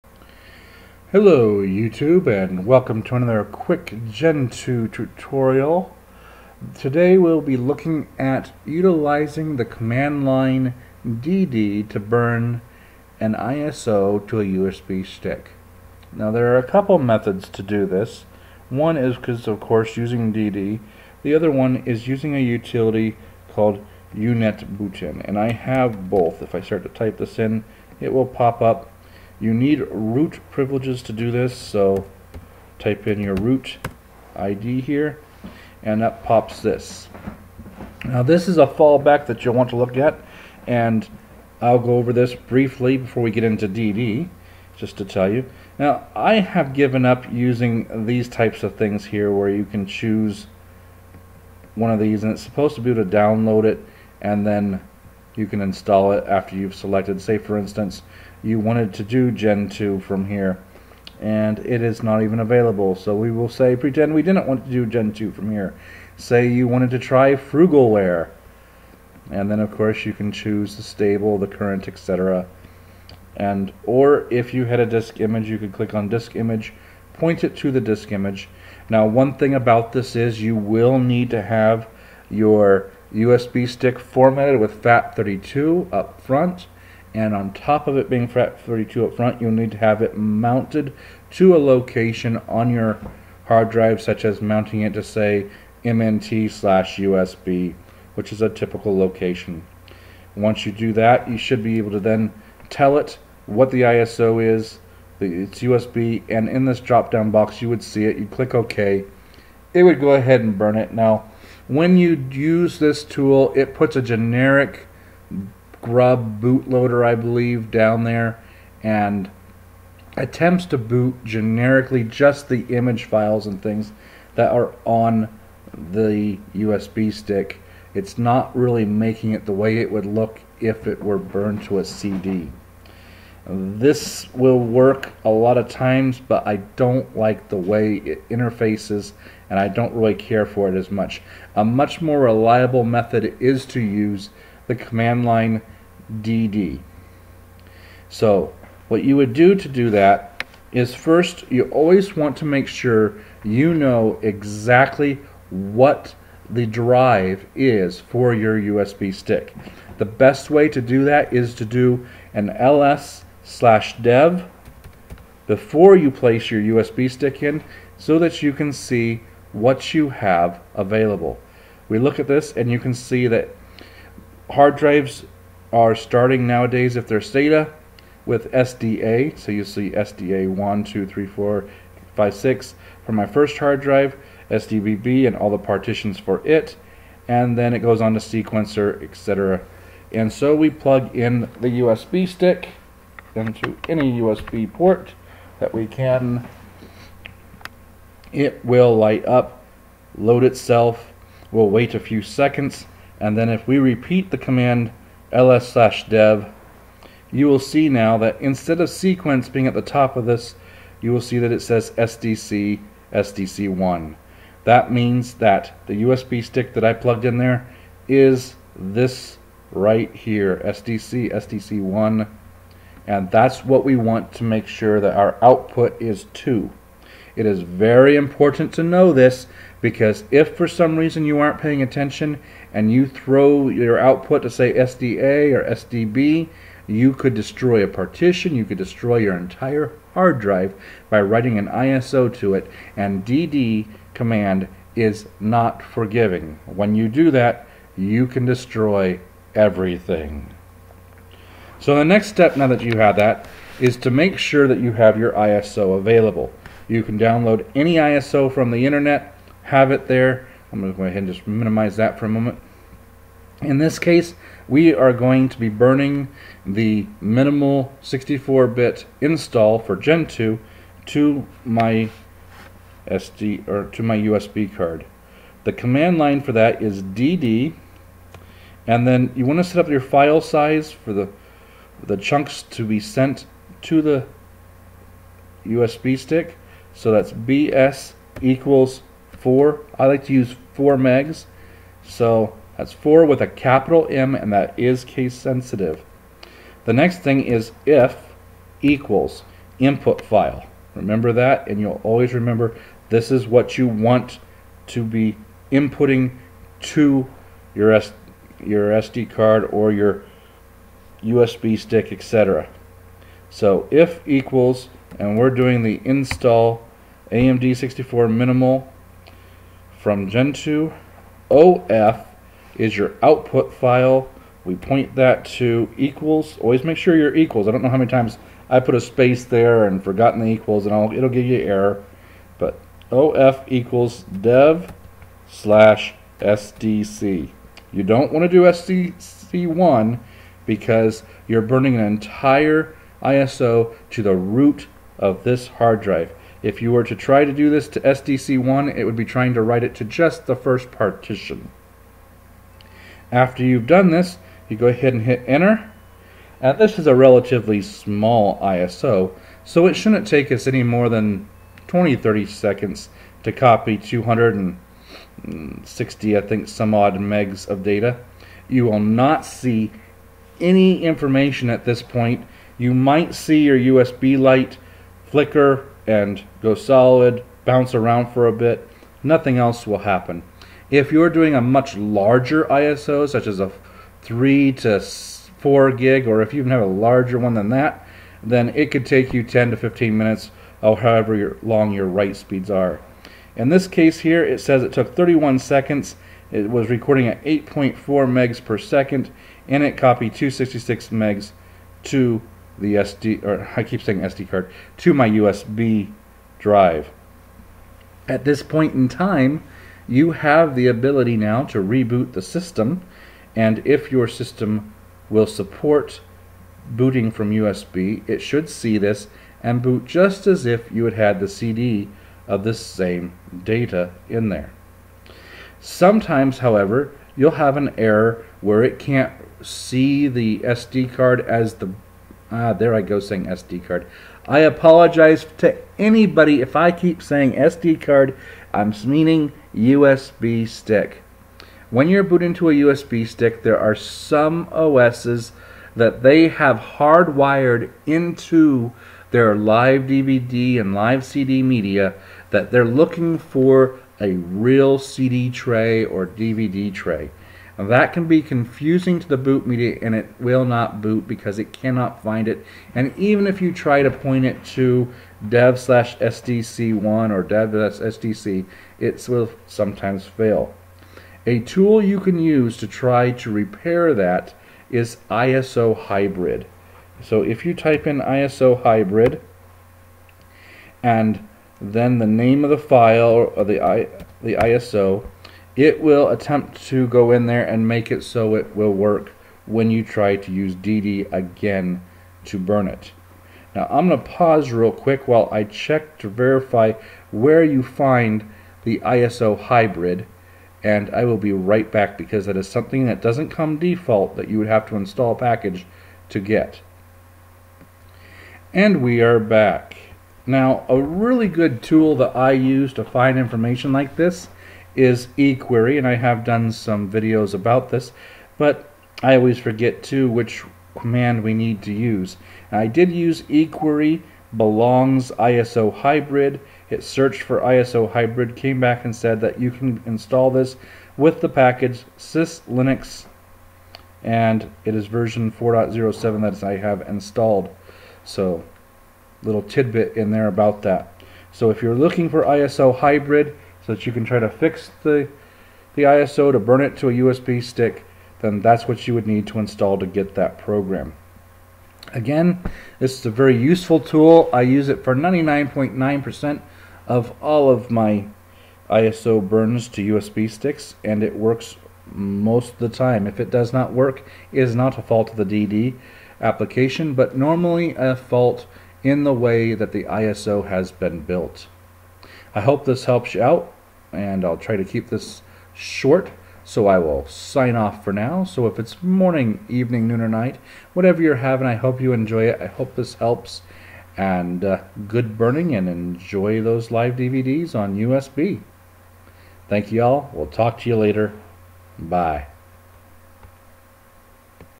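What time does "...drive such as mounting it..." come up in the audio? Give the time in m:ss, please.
1:33.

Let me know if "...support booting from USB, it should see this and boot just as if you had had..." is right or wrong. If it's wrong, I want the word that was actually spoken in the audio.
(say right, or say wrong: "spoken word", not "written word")
right.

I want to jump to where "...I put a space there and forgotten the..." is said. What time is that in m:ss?
5:28.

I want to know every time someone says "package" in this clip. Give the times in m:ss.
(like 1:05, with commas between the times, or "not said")
8:25, 8:51.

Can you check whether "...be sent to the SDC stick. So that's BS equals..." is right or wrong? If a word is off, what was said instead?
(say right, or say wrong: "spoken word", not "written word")
wrong: "USB", not "SDC".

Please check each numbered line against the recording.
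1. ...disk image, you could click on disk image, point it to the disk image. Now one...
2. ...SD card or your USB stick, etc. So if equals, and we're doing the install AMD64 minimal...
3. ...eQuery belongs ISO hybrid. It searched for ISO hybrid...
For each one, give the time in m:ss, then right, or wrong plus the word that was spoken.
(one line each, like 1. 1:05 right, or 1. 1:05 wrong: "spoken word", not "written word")
1. 1:14 right
2. 5:08 right
3. 8:43 right.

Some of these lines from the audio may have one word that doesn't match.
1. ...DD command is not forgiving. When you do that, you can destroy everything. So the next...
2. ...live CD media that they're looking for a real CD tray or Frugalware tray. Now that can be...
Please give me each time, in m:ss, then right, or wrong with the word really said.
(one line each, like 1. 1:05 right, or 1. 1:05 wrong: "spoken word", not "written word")
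1. 4:03 right
2. 7:30 wrong: "DVD", not "Frugalware".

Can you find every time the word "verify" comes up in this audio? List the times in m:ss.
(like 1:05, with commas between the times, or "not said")
8:16.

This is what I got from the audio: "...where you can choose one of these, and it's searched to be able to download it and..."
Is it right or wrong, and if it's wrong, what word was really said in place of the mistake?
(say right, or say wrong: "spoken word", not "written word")
wrong: "supposed", not "searched".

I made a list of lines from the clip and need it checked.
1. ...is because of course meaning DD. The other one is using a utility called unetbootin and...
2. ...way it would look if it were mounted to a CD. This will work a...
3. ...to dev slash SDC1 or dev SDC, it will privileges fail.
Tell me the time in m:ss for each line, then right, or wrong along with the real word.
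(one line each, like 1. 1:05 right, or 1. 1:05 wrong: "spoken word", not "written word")
1. 0:18 wrong: "using", not "meaning"
2. 2:09 wrong: "burned", not "mounted"
3. 7:44 wrong: "sometimes", not "privileges".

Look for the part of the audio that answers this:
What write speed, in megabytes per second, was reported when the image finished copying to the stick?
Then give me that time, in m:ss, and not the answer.
6:37.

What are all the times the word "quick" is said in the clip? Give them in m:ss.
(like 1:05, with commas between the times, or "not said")
0:03, 8:14.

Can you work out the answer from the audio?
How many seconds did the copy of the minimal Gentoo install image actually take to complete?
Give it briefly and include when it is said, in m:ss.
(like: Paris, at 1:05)
31, at 6:35.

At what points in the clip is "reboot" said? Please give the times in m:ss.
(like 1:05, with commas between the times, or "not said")
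6:51.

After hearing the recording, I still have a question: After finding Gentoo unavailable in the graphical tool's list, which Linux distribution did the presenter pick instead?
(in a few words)
Frugalware.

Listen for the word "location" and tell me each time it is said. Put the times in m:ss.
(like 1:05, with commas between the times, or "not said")
1:31, 1:38.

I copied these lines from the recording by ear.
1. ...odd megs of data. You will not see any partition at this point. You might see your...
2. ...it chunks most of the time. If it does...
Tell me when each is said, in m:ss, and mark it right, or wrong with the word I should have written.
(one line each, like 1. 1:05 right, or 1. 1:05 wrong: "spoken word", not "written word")
1. 6:06 wrong: "information", not "partition"
2. 9:21 wrong: "works", not "chunks".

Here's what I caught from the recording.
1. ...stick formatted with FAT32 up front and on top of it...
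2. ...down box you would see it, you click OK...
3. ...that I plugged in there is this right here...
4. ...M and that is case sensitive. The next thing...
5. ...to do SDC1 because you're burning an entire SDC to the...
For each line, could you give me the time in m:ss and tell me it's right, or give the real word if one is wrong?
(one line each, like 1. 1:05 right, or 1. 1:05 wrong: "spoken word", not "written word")
1. 1:23 right
2. 1:47 right
3. 3:36 right
4. 4:54 right
5. 5:38 wrong: "ISO", not "SDC".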